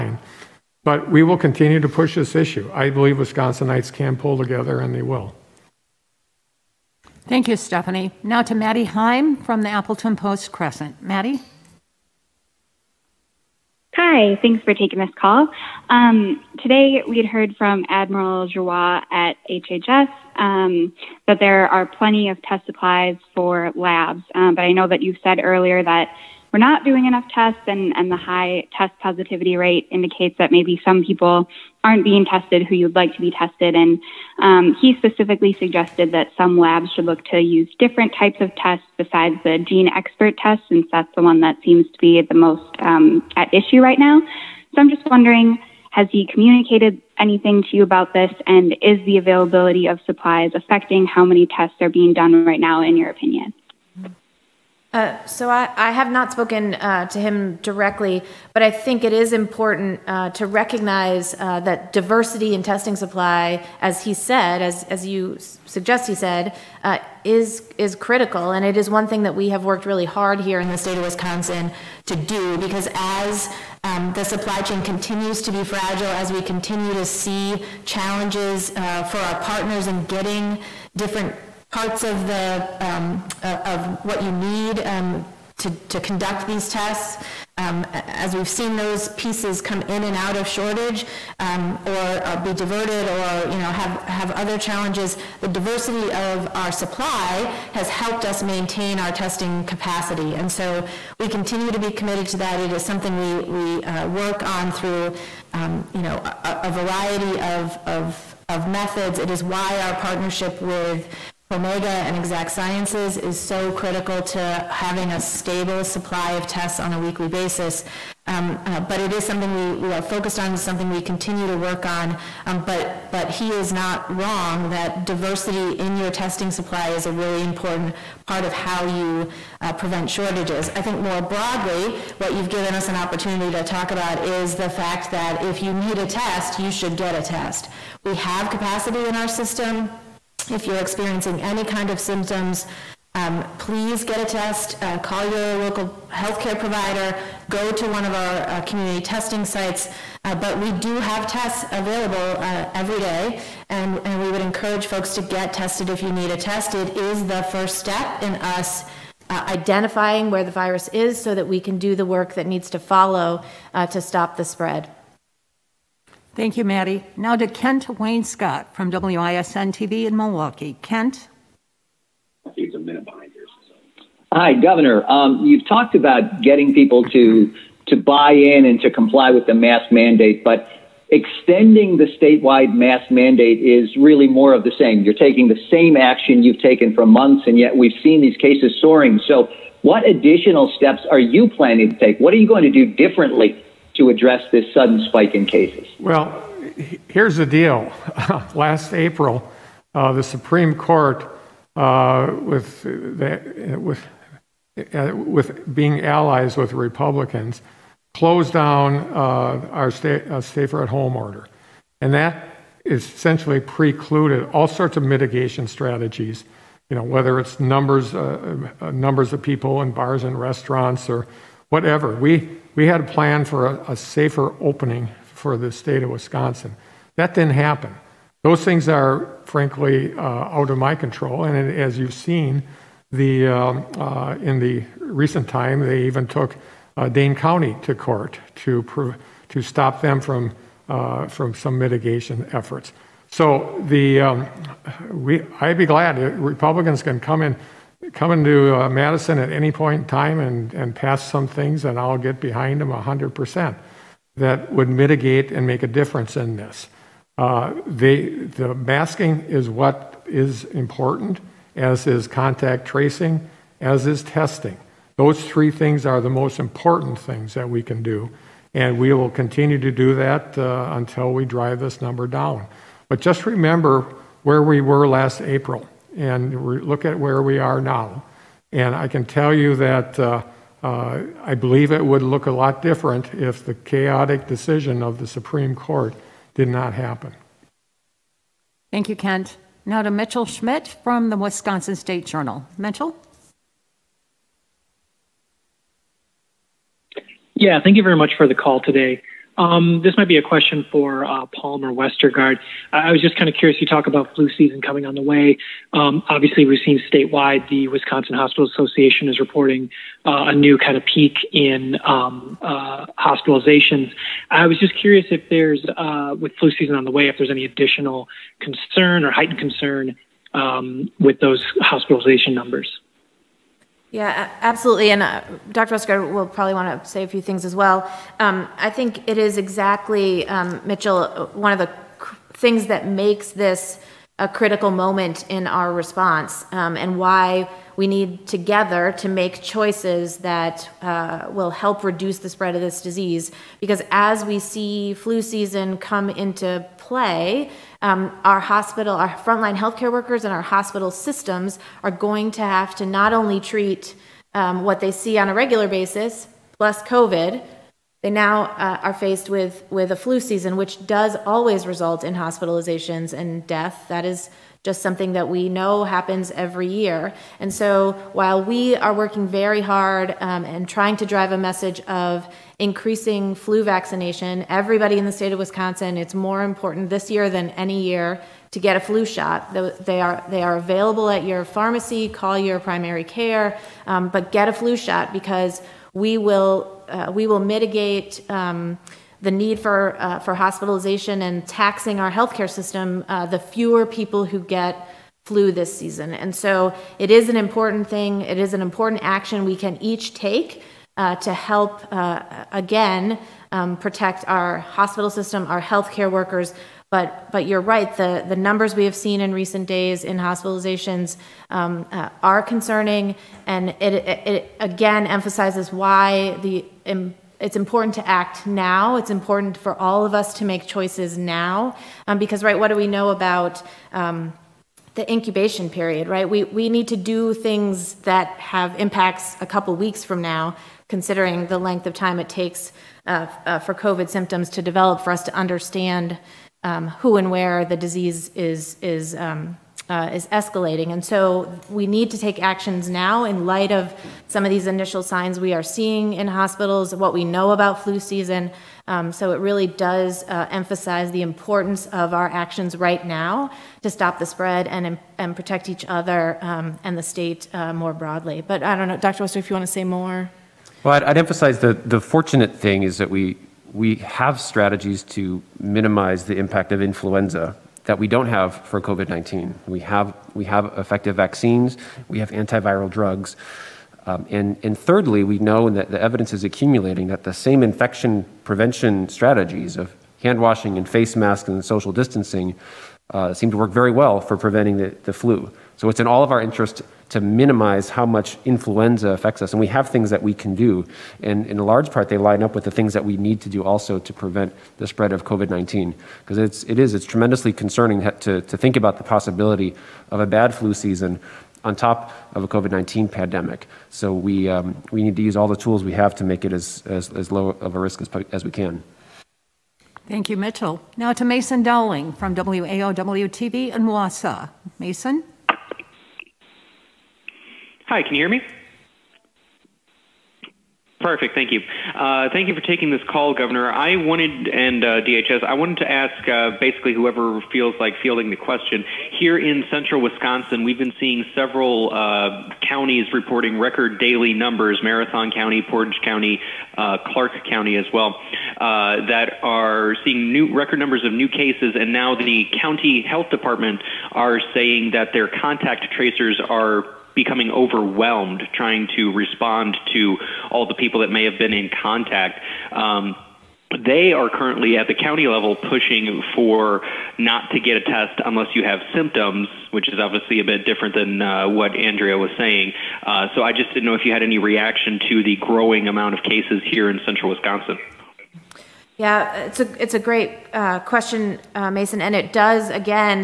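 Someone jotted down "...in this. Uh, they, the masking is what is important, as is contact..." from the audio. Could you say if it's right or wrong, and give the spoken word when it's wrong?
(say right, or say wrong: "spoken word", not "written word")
right.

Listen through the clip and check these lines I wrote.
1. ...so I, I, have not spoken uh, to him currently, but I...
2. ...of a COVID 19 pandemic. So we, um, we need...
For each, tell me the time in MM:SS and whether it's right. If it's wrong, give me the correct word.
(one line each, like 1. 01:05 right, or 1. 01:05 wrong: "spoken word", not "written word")
1. 00:55 wrong: "directly", not "currently"
2. 08:22 right.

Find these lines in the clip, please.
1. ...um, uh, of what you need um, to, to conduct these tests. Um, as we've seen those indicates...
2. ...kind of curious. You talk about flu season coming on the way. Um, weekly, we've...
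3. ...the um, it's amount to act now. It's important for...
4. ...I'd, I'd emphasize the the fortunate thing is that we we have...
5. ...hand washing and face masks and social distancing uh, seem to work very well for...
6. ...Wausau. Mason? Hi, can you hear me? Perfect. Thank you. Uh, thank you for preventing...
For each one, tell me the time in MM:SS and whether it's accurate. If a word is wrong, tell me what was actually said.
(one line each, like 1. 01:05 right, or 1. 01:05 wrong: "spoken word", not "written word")
1. 01:22 wrong: "pieces", not "indicates"
2. 05:03 wrong: "obviously", not "weekly"
3. 06:56 wrong: "important", not "amount"
4. 07:41 right
5. 08:00 right
6. 08:34 wrong: "taking", not "preventing".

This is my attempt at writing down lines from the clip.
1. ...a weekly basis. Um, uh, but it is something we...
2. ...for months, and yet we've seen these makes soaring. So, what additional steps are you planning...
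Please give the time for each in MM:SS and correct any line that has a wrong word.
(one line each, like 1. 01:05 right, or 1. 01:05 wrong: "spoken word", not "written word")
1. 01:56 right
2. 03:06 wrong: "cases", not "makes".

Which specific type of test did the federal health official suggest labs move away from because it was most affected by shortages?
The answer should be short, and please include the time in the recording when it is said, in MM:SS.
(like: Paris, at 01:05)
GeneXpert, at 00:39.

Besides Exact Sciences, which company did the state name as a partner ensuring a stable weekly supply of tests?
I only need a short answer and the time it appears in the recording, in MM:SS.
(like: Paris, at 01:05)
Promega, at 01:51.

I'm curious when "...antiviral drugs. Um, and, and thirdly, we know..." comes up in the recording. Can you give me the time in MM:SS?
07:52.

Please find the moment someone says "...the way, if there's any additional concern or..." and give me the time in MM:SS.
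05:17.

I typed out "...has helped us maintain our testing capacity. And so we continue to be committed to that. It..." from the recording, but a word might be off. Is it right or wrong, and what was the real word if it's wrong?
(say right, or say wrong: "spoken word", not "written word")
right.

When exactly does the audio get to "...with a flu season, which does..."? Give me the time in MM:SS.
05:59.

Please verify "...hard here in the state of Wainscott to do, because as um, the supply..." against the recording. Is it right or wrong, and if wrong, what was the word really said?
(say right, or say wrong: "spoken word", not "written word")
wrong: "Wisconsin", not "Wainscott".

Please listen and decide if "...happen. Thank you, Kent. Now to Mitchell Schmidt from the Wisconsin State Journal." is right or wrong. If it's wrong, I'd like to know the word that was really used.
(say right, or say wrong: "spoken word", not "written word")
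right.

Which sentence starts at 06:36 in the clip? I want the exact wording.
And so it is an important thing.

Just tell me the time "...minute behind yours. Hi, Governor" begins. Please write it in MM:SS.
02:52.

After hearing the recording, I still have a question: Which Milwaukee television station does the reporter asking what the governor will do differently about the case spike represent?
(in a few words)
WISN TV.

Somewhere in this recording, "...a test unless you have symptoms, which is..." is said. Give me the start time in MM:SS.
09:17.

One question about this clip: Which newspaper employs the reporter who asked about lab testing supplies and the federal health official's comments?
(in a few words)
Appleton Post-Crescent.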